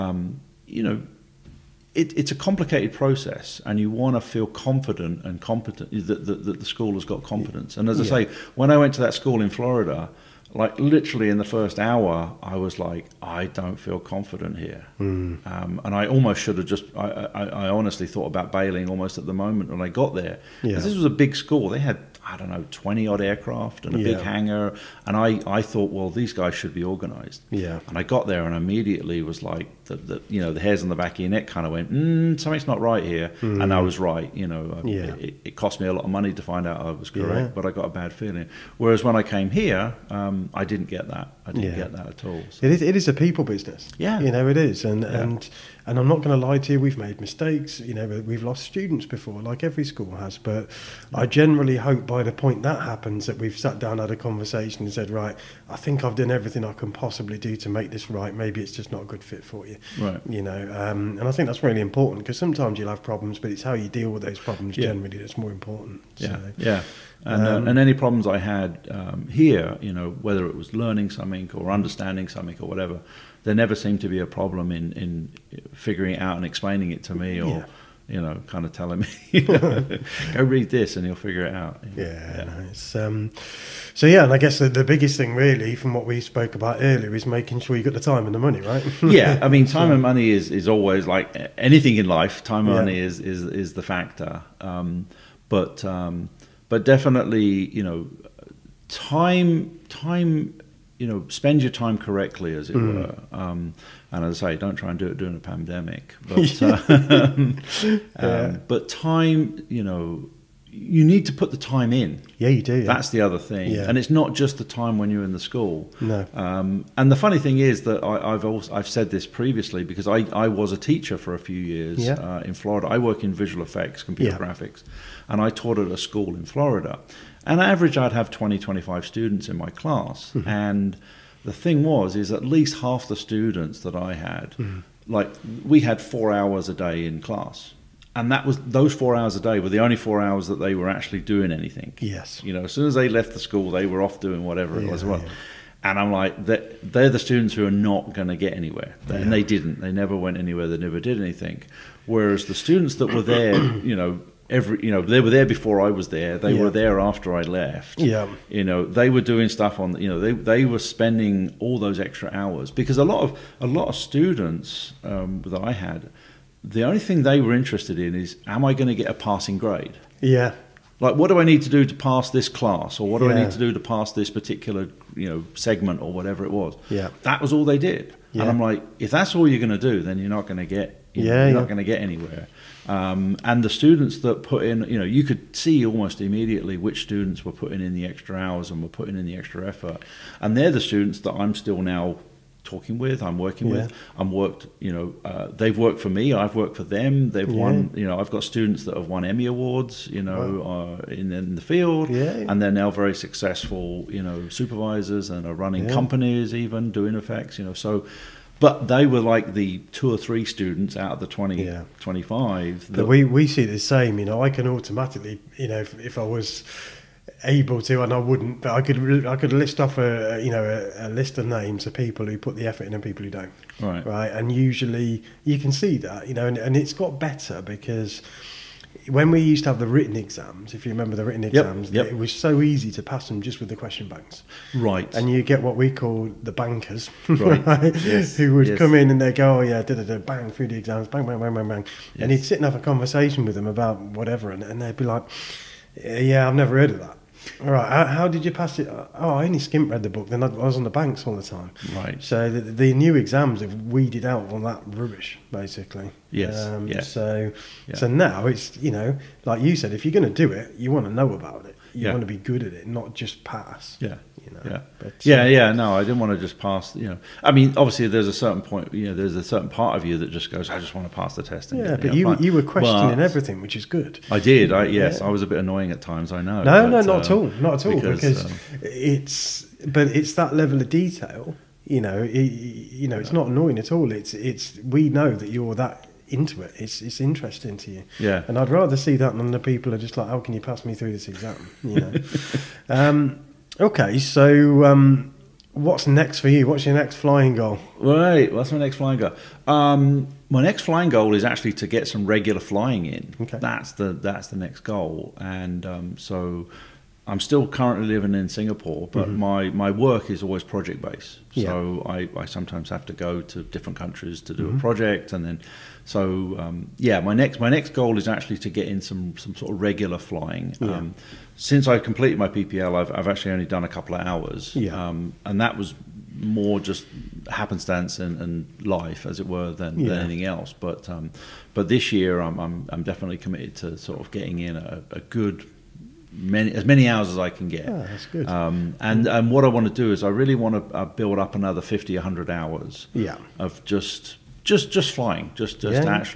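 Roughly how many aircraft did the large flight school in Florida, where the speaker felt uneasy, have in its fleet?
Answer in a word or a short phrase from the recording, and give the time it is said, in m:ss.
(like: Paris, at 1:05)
20 odd, at 0:22.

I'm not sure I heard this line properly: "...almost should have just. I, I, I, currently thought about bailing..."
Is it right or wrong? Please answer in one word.
wrong.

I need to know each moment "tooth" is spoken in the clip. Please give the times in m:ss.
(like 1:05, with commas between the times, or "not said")
not said.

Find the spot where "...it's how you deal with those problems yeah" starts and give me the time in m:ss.
1:03.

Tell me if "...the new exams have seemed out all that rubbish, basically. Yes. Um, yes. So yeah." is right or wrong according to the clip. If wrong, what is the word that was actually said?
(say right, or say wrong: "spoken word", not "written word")
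wrong: "weeded", not "seemed".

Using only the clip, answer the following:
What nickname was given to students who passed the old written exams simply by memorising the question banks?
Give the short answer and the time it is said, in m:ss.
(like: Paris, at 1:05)
The bankers, at 3:56.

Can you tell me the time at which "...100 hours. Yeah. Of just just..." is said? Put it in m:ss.
5:42.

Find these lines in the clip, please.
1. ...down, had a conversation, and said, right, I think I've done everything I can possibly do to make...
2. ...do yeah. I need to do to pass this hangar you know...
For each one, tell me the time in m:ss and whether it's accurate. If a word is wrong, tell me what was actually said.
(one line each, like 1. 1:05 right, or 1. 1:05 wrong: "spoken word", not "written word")
1. 0:53 right
2. 2:53 wrong: "particular", not "hangar".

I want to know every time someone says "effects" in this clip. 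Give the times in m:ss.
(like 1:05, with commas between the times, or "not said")
2:03, 3:27.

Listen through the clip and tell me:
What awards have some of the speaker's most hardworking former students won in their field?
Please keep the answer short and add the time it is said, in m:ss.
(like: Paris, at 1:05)
Emmy Awards, at 3:19.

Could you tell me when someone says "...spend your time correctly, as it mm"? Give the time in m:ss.
1:41.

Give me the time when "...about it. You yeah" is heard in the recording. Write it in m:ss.
4:21.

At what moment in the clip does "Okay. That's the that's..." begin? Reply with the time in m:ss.
5:03.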